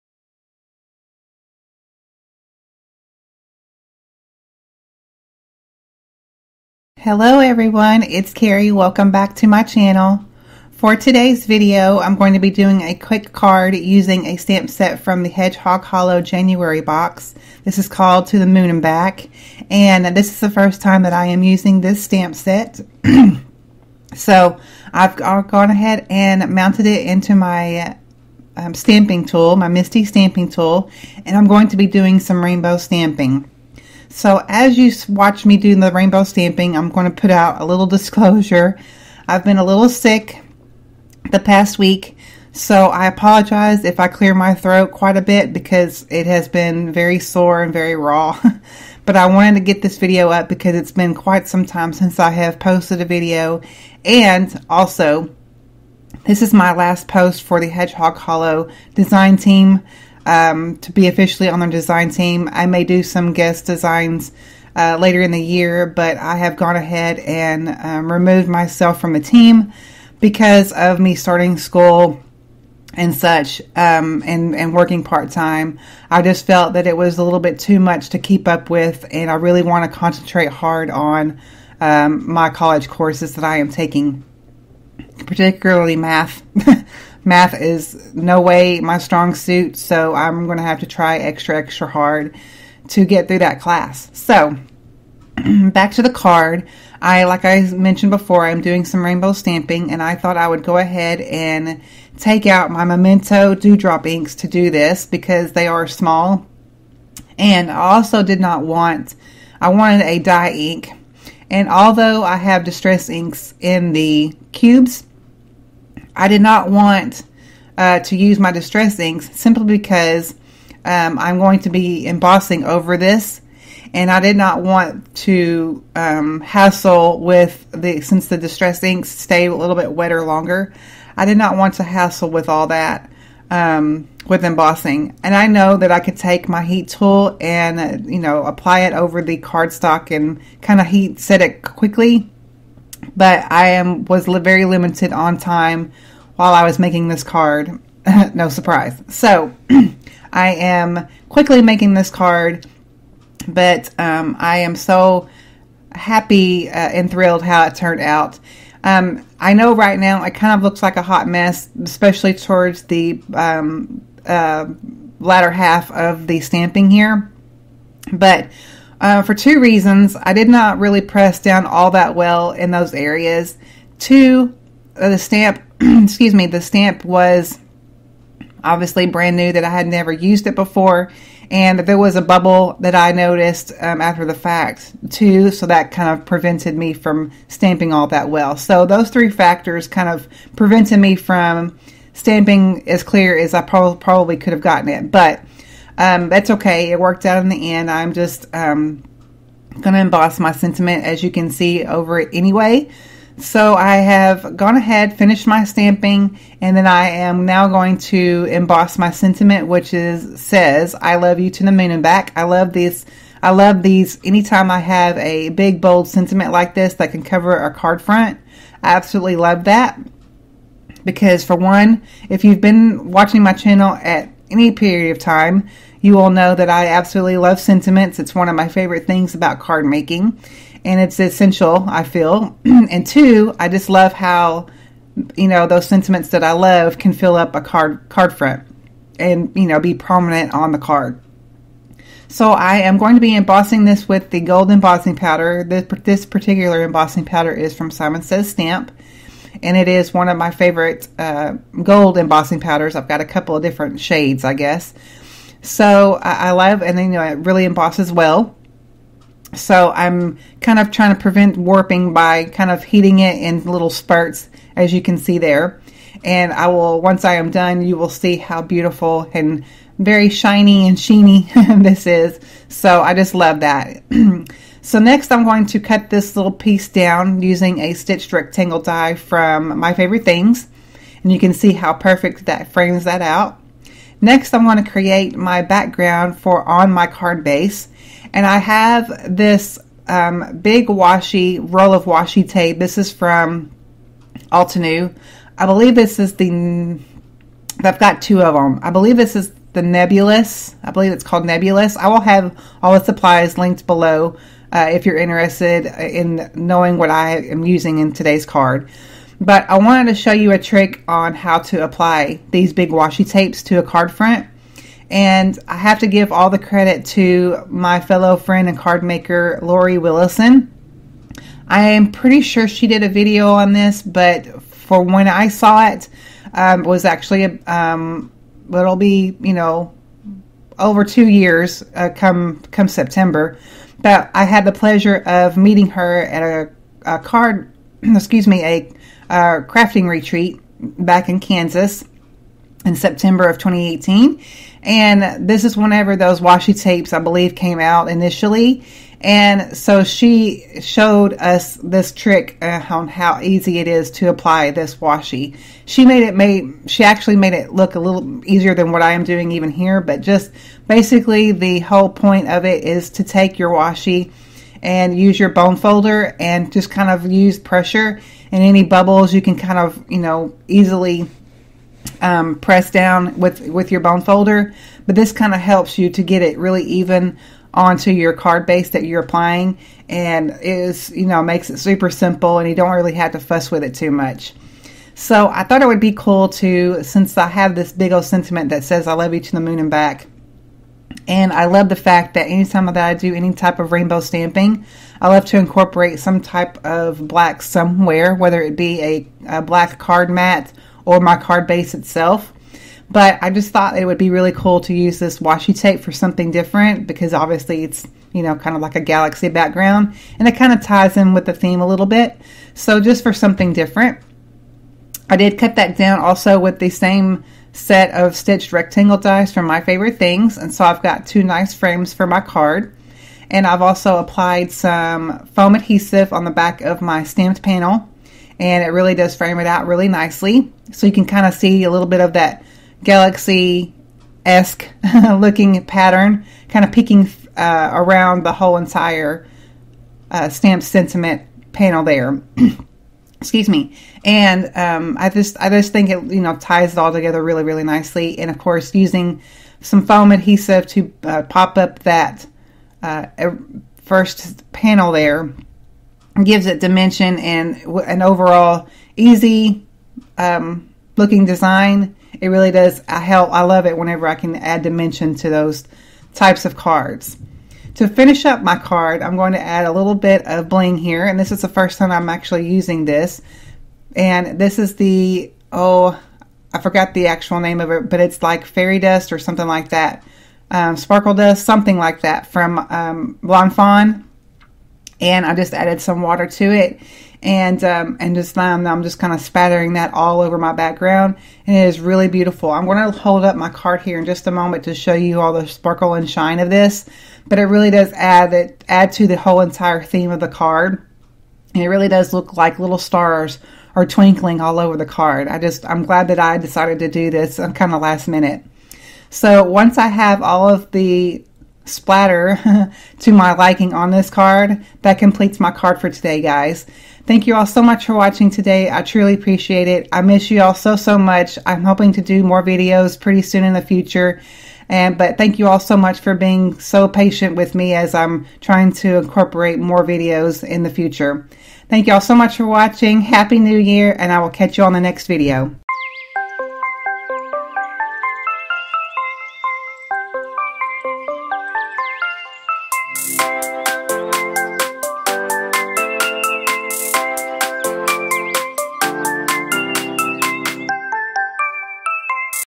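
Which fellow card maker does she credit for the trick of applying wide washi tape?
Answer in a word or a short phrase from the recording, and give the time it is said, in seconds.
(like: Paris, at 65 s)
Lori Willison, at 319 s.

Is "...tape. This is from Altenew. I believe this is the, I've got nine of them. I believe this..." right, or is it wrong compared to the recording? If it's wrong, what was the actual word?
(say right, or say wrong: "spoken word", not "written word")
wrong: "two", not "nine".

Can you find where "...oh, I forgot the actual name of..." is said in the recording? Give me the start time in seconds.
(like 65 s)
475 s.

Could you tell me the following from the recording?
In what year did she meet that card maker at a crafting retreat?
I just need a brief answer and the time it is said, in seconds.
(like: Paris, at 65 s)
2018, at 343 s.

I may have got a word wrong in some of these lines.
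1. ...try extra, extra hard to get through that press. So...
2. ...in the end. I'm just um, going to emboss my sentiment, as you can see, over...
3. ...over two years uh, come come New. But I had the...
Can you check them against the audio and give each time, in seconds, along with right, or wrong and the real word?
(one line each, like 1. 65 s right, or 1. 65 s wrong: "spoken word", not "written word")
1. 90 s wrong: "class", not "press"
2. 197 s right
3. 330 s wrong: "September", not "New".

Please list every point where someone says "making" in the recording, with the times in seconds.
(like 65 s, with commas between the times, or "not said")
146 s, 151 s, 229 s.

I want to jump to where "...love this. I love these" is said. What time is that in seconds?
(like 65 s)
212 s.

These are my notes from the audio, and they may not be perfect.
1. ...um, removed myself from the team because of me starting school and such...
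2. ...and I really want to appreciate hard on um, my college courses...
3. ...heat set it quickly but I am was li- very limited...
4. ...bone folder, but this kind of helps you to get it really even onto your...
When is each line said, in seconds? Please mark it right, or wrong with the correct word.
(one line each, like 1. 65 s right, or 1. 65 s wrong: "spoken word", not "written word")
1. 67 s right
2. 79 s wrong: "concentrate", not "appreciate"
3. 140 s right
4. 373 s right.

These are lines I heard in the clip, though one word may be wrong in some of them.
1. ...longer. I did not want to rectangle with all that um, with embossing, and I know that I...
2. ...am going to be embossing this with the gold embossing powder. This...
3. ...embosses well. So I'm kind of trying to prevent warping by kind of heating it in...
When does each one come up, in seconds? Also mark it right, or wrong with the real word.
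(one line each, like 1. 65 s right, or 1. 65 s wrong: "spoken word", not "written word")
1. 130 s wrong: "hassle", not "rectangle"
2. 242 s right
3. 257 s right.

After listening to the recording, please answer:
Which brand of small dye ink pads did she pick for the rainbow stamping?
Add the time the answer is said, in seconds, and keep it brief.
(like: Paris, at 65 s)
Memento Dewdrop, at 102 s.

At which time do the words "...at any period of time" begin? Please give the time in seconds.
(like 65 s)
224 s.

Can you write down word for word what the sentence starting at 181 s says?
And there was a bubble that I noticed um, after the fact, too.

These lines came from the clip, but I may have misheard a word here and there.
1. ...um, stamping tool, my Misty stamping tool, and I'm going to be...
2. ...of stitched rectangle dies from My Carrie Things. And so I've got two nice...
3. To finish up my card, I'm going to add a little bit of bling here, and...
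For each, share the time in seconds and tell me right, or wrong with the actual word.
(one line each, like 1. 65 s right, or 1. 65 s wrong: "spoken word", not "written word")
1. 28 s right
2. 418 s wrong: "Favorite", not "Carrie"
3. 467 s right.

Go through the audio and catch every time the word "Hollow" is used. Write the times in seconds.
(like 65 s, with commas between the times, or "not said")
15 s, 58 s.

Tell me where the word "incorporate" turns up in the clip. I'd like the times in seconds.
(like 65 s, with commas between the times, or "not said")
395 s, 529 s.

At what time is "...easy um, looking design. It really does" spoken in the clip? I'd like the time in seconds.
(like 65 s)
459 s.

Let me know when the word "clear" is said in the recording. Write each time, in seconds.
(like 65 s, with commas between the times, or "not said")
44 s, 193 s.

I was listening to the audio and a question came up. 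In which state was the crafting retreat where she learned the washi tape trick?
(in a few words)
Kansas.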